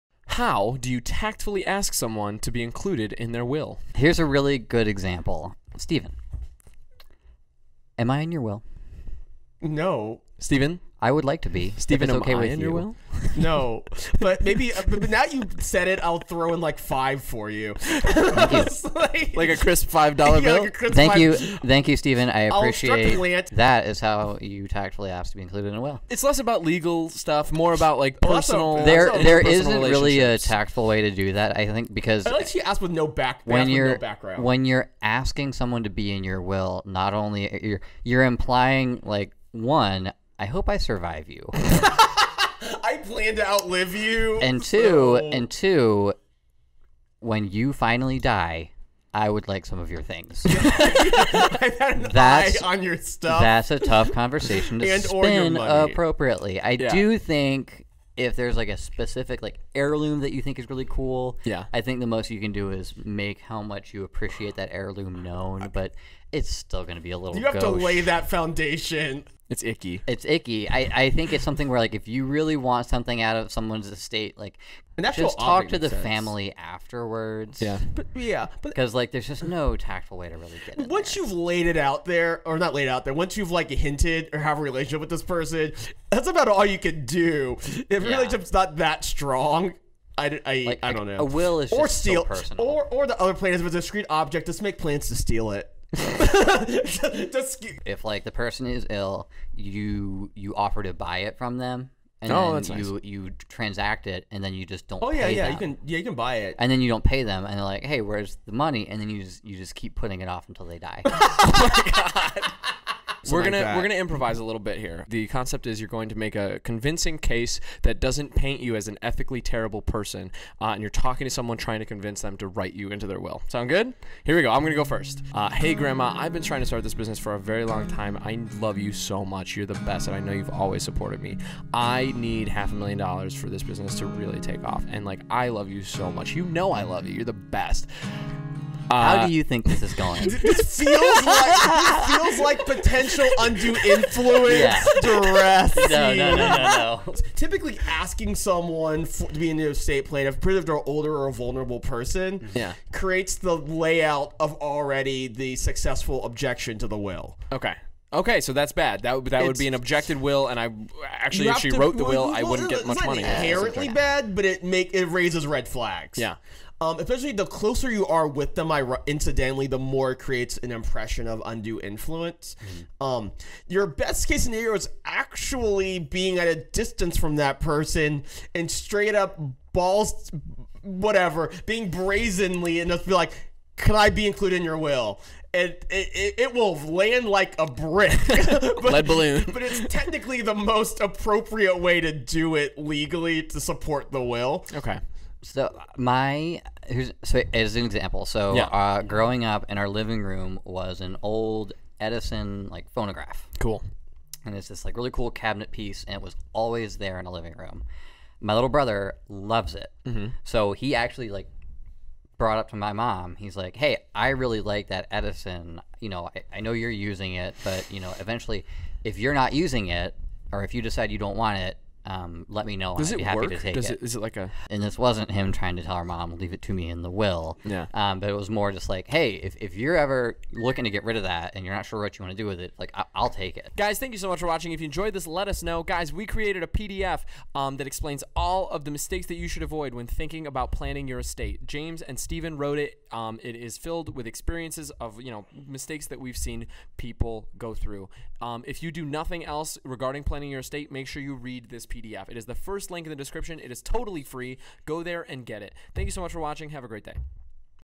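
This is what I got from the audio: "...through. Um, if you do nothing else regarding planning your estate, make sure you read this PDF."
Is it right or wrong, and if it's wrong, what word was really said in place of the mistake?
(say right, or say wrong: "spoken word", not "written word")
right.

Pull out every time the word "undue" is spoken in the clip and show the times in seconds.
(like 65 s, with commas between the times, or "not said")
143 s, 171 s.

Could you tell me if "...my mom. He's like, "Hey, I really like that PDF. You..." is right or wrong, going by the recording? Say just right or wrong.
wrong.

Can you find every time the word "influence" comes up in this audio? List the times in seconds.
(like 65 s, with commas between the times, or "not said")
143 s, 171 s.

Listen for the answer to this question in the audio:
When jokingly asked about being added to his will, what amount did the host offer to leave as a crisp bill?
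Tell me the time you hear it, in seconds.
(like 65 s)
19 s.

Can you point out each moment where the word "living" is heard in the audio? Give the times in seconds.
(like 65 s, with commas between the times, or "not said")
199 s, 207 s.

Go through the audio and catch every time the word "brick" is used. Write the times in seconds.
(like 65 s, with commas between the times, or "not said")
187 s.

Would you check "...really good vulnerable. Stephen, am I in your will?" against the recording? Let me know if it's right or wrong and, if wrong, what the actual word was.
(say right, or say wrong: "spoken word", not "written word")
wrong: "example", not "vulnerable".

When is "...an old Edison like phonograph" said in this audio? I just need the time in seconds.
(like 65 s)
201 s.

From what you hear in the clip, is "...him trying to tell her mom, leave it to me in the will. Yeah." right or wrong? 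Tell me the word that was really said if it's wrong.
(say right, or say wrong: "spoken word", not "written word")
right.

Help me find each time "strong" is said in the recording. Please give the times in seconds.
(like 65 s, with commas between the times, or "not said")
89 s.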